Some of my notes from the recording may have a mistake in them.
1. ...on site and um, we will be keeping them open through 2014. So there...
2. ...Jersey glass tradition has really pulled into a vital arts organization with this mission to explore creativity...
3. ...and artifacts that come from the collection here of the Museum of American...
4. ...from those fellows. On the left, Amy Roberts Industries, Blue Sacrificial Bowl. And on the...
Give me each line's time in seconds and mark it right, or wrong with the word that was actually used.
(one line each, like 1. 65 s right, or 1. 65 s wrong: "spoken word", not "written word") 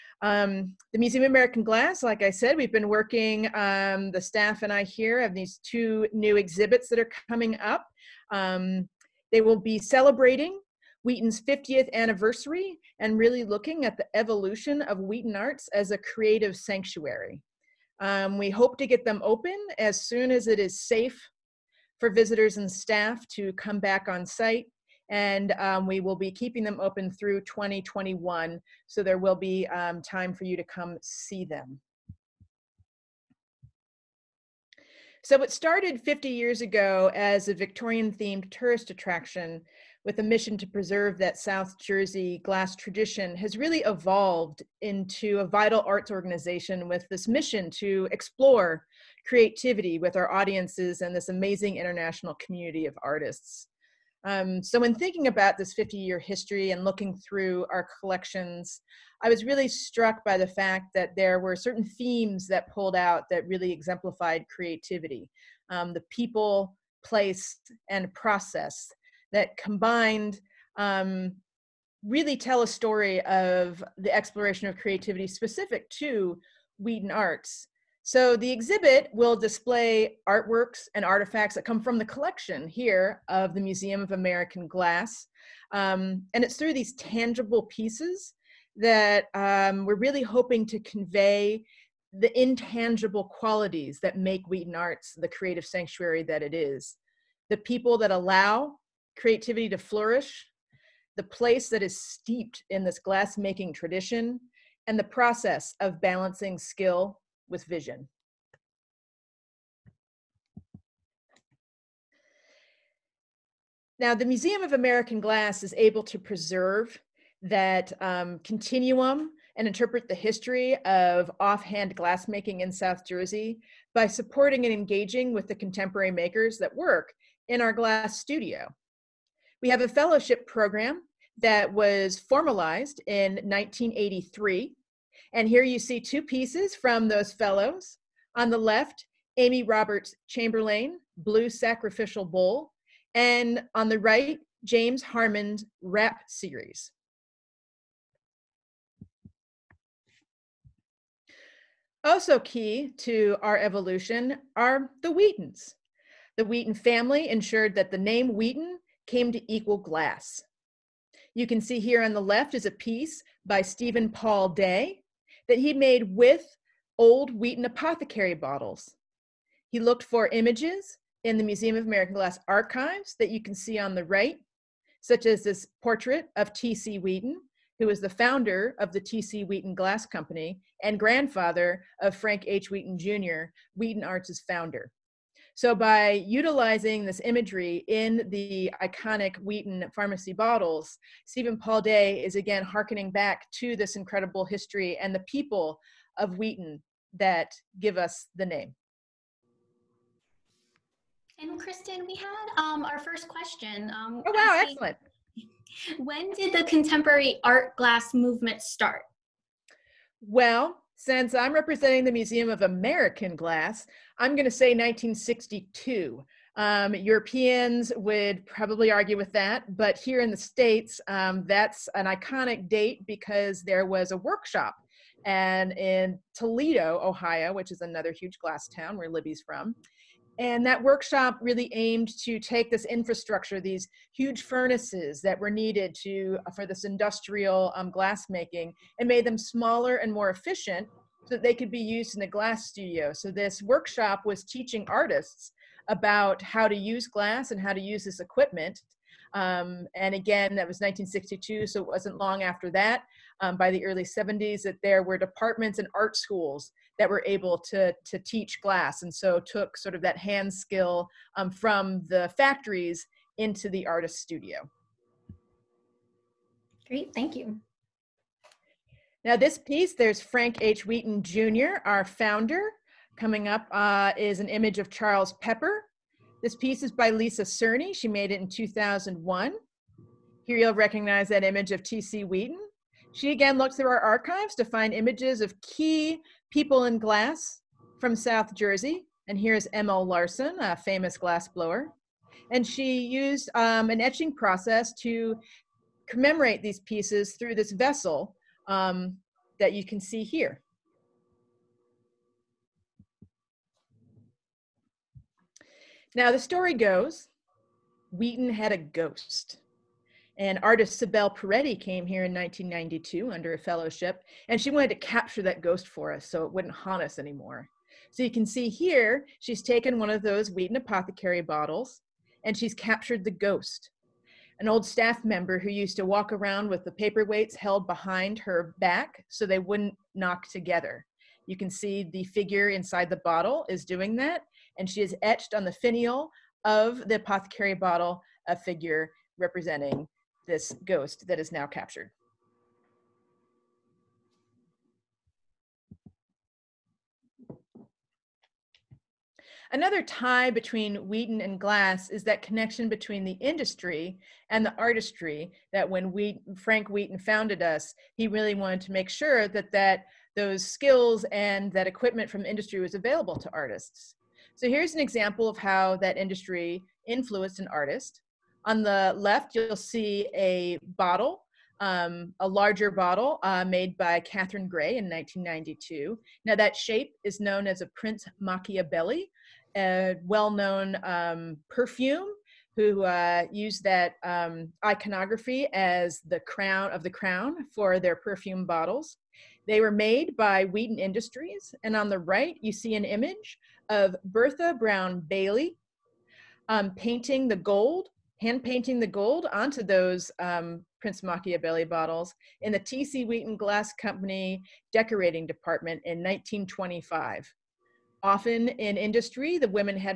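1. 24 s wrong: "2021", not "2014"
2. 41 s wrong: "evolved", not "pulled"
3. 80 s right
4. 136 s wrong: "Chamberlain", not "Industries".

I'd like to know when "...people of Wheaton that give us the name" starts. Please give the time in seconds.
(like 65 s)
195 s.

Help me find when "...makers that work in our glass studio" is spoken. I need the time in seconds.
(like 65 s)
126 s.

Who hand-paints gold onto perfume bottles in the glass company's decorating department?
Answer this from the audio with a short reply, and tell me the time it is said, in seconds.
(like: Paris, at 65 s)
Bertha Brown Bailey, at 394 s.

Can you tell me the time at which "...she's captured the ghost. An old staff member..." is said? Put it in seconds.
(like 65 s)
322 s.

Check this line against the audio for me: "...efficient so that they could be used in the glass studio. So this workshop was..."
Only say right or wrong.
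right.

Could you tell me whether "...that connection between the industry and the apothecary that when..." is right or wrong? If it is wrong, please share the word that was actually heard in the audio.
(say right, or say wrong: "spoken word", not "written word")
wrong: "artistry", not "apothecary".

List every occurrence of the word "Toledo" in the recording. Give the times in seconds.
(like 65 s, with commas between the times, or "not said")
226 s.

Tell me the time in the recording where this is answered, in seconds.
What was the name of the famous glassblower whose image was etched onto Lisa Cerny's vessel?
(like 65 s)
289 s.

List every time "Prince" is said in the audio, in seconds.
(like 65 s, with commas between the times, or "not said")
377 s, 401 s.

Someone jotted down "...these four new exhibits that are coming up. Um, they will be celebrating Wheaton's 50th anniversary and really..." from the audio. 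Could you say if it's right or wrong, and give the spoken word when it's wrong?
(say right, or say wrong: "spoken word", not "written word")
wrong: "two", not "four".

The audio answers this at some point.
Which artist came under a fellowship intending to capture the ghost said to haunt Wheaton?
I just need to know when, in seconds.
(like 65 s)
311 s.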